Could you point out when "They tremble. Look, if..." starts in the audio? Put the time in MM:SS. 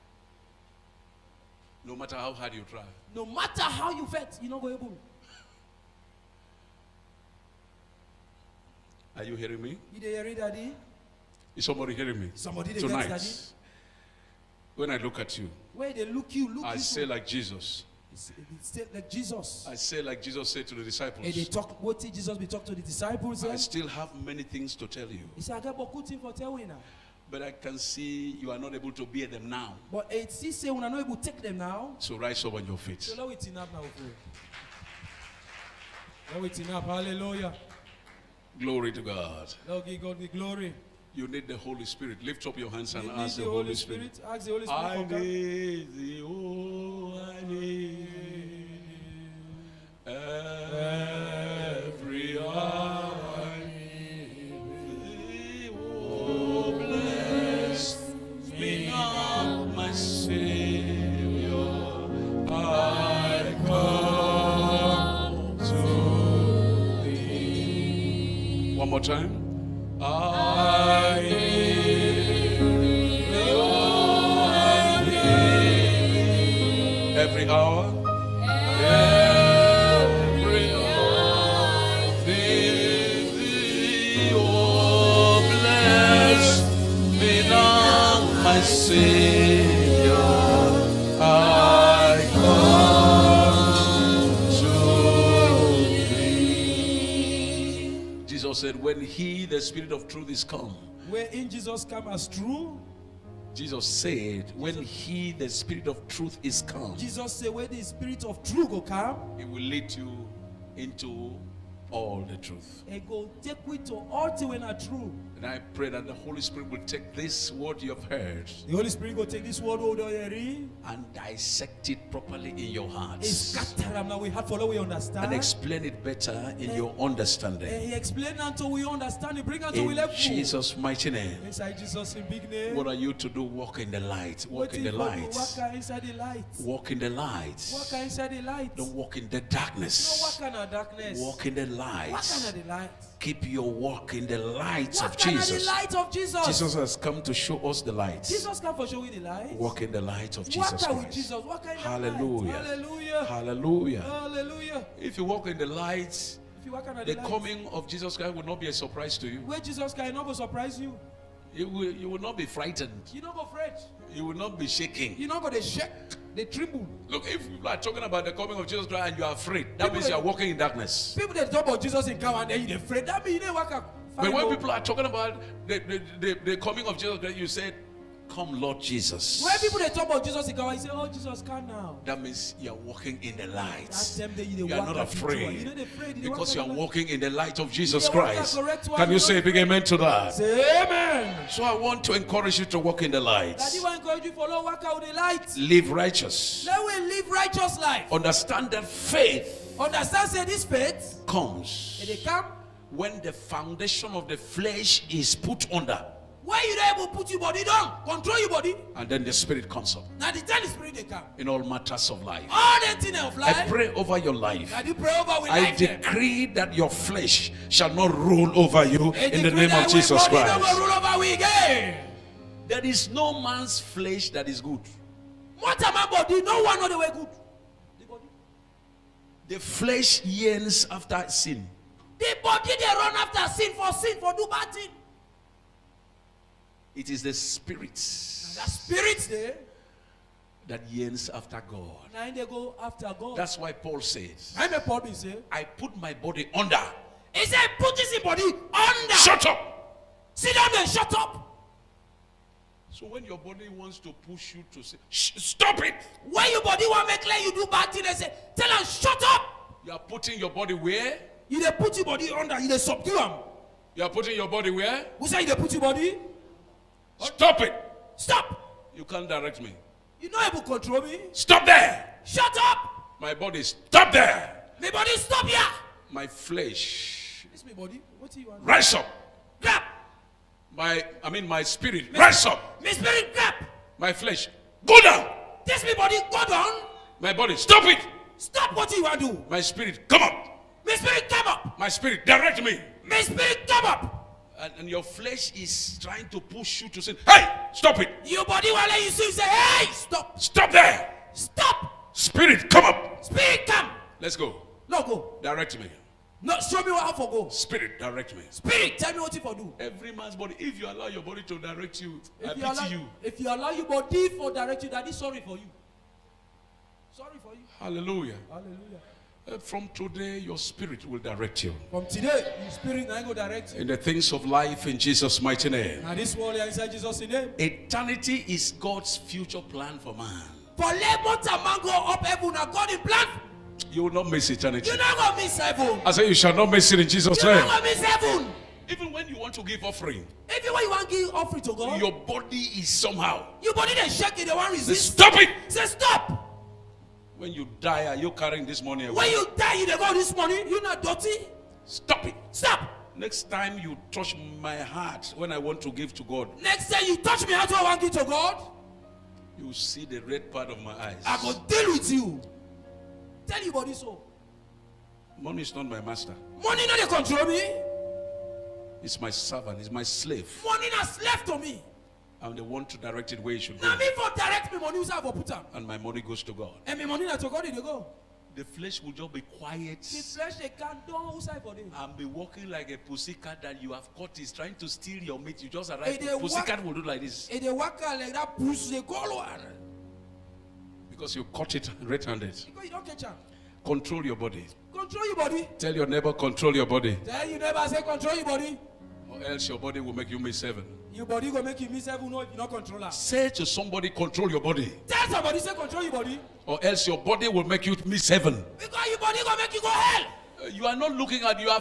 02:46.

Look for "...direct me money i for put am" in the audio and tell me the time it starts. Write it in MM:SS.
06:14.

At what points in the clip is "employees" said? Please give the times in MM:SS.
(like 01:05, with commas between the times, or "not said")
not said.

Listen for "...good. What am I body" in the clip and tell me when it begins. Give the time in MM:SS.
03:44.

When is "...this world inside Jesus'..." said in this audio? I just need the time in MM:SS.
05:26.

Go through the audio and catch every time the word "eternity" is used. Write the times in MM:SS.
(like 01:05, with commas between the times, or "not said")
05:27, 05:34.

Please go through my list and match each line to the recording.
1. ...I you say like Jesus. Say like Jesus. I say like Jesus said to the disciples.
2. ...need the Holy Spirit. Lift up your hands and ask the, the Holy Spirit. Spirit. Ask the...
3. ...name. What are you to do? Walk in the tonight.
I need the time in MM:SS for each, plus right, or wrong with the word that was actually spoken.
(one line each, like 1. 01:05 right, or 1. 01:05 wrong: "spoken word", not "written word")
1. 00:16 right
2. 00:41 right
3. 02:11 wrong: "light", not "tonight".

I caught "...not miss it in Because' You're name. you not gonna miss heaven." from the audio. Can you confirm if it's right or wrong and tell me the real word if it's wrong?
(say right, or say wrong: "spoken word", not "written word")
wrong: "Jesus", not "Because".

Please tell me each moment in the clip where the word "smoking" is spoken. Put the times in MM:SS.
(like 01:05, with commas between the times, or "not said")
not said.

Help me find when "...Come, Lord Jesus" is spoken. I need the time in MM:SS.
02:58.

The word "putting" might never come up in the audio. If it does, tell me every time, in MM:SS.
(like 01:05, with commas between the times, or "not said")
04:19, 04:24.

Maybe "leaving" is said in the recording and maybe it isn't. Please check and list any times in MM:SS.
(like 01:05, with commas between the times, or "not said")
not said.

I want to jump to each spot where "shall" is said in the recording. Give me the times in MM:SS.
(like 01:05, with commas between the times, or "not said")
03:37, 05:36.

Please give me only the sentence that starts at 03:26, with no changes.
Where you not able to put your body down, control your body?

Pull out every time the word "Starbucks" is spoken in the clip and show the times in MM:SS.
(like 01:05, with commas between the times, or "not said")
not said.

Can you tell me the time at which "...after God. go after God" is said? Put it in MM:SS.
04:01.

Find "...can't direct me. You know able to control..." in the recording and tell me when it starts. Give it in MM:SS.
04:29.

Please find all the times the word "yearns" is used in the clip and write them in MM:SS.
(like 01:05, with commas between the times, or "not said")
03:50, 04:00.